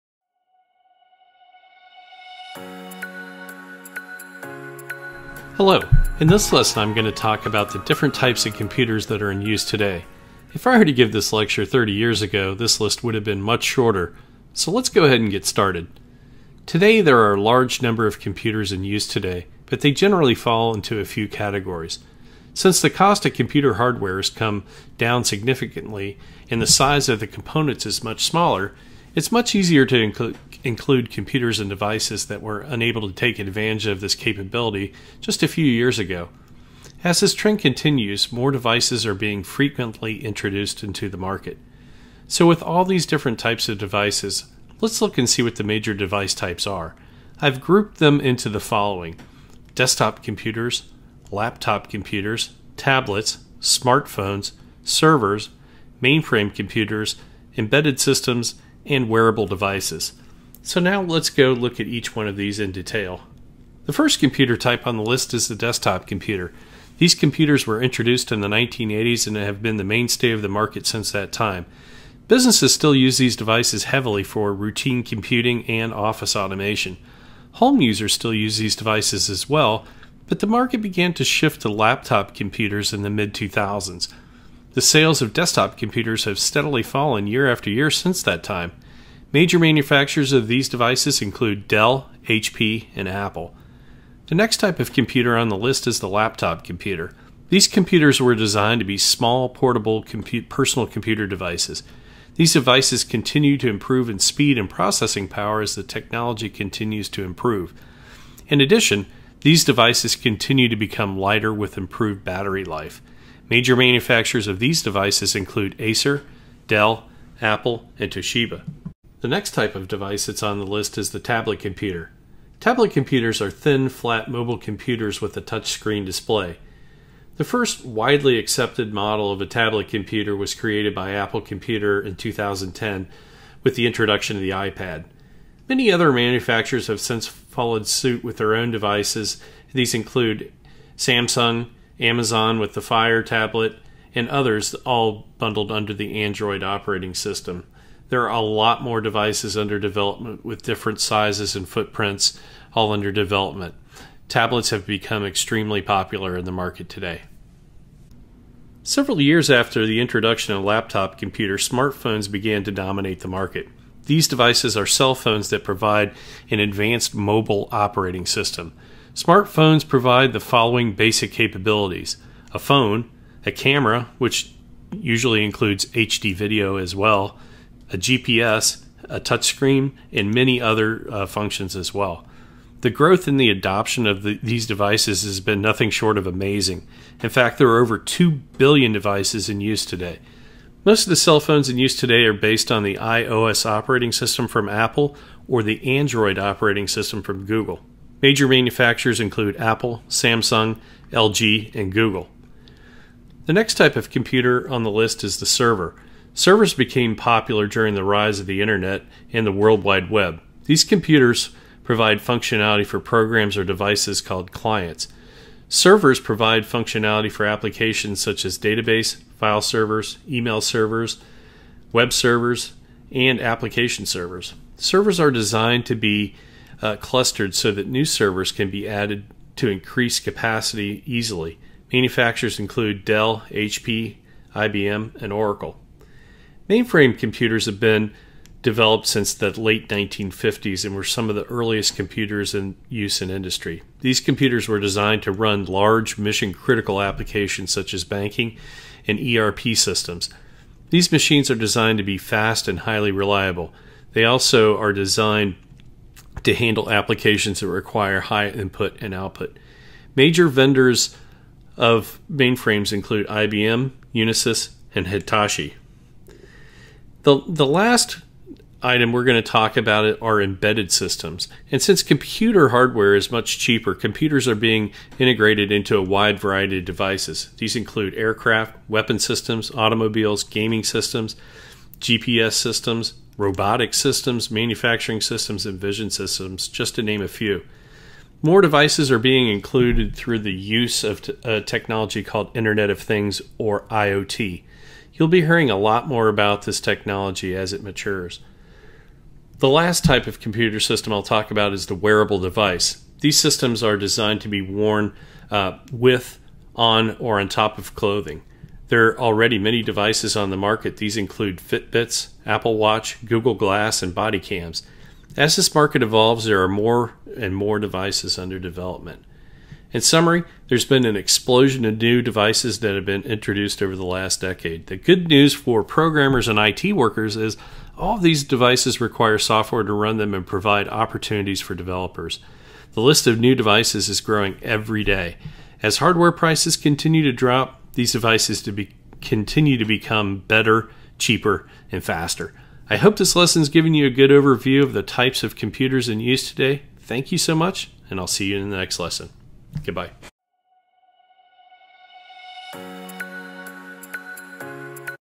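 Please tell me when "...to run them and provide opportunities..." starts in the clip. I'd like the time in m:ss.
5:29.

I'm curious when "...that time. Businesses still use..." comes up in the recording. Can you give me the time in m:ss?
1:11.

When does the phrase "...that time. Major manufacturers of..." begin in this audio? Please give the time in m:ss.
1:28.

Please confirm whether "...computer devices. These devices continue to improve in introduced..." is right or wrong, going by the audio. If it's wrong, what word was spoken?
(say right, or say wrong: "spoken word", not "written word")
wrong: "speed", not "introduced".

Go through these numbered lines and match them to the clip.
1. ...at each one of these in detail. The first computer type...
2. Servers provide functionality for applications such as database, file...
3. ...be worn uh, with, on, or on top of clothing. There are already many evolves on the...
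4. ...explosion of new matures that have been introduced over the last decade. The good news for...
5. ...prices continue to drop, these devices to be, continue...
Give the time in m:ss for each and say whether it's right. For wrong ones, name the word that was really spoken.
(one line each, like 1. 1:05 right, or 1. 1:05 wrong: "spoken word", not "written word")
1. 1:01 right
2. 3:35 right
3. 5:04 wrong: "devices", not "evolves"
4. 5:21 wrong: "devices", not "matures"
5. 5:36 right.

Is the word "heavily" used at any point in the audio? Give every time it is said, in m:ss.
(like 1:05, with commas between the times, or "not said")
1:13.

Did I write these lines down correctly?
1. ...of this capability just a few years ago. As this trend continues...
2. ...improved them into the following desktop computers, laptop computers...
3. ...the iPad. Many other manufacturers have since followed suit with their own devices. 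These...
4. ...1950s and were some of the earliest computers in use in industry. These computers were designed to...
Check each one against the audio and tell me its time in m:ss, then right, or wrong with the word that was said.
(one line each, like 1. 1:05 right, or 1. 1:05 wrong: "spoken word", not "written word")
1. 0:33 right
2. 0:47 wrong: "grouped", not "improved"
3. 2:14 right
4. 3:59 right.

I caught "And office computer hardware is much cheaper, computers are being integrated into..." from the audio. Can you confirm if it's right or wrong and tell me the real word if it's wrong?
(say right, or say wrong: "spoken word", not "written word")
wrong: "since", not "office".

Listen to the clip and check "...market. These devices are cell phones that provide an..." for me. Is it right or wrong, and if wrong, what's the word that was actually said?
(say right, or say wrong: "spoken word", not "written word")
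right.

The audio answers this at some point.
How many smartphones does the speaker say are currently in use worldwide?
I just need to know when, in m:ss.
3:07.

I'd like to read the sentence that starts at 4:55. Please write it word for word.
You'll be hearing a lot more about this technology as it matures.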